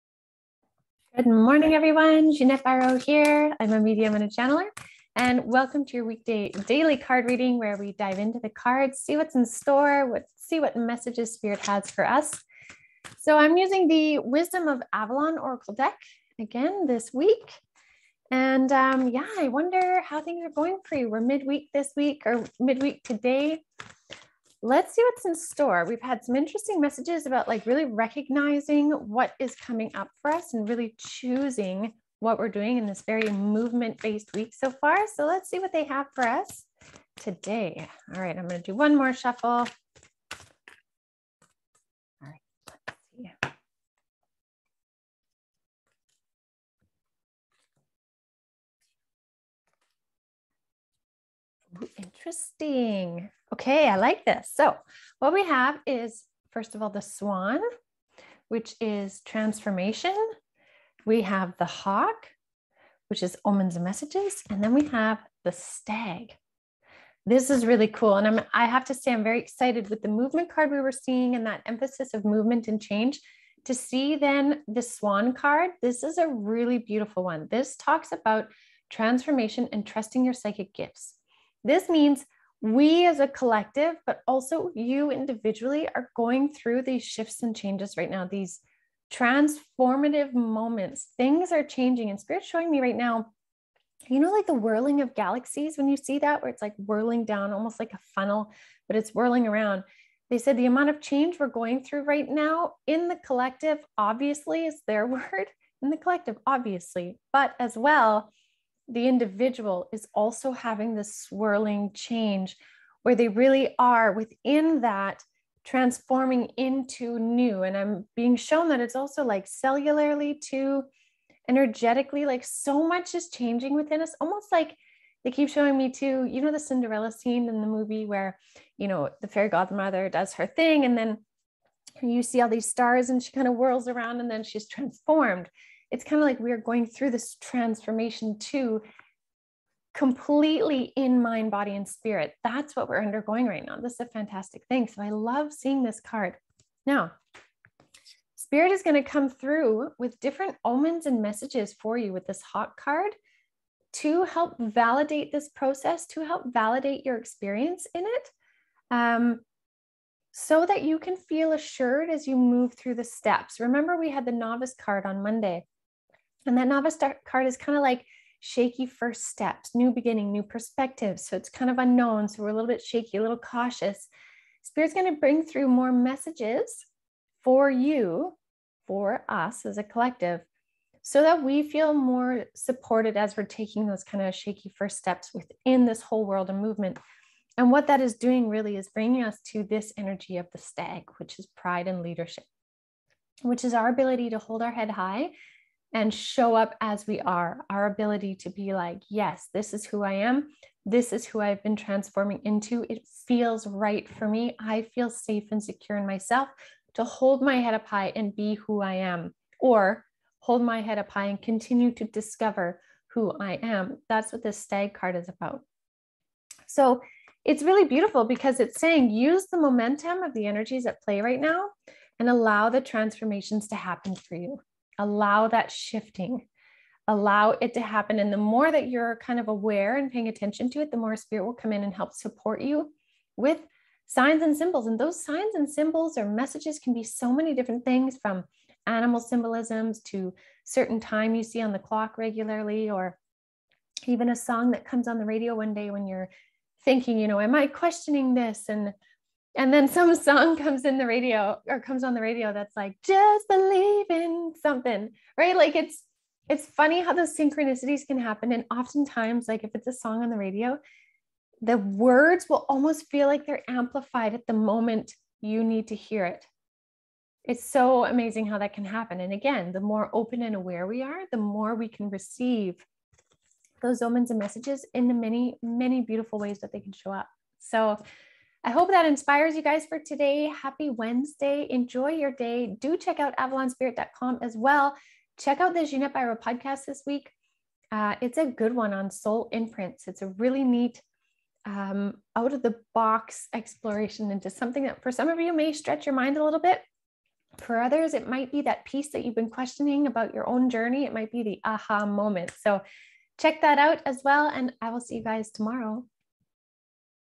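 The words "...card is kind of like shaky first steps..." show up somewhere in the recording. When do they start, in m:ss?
2:47.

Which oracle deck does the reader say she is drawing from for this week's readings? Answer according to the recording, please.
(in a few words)
Wisdom of Avalon Oracle.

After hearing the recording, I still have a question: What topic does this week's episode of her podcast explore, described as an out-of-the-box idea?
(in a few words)
soul imprints.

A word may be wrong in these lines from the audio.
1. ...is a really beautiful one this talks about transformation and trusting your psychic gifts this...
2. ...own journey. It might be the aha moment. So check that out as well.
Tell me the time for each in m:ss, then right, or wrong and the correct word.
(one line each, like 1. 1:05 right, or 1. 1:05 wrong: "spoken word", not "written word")
1. 1:16 right
2. 5:00 right.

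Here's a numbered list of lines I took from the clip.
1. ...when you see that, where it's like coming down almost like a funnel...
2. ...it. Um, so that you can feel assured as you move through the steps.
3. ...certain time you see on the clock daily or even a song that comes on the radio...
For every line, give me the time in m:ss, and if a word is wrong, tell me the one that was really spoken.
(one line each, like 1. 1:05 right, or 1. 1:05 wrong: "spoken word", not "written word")
1. 1:35 wrong: "whirling", not "coming"
2. 2:38 right
3. 4:00 wrong: "regularly", not "daily".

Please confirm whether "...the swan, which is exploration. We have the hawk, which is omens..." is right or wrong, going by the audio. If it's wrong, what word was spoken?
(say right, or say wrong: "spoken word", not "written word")
wrong: "transformation", not "exploration".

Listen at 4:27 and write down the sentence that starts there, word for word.
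It's so amazing how that can happen.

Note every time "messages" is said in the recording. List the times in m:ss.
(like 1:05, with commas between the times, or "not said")
0:10, 0:26, 1:03, 2:31, 2:55, 3:56, 4:34.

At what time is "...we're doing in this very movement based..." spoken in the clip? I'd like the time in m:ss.
0:32.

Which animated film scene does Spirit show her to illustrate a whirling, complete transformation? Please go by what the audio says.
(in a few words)
Cinderella.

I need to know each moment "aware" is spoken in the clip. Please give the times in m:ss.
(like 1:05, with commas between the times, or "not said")
3:49, 4:30.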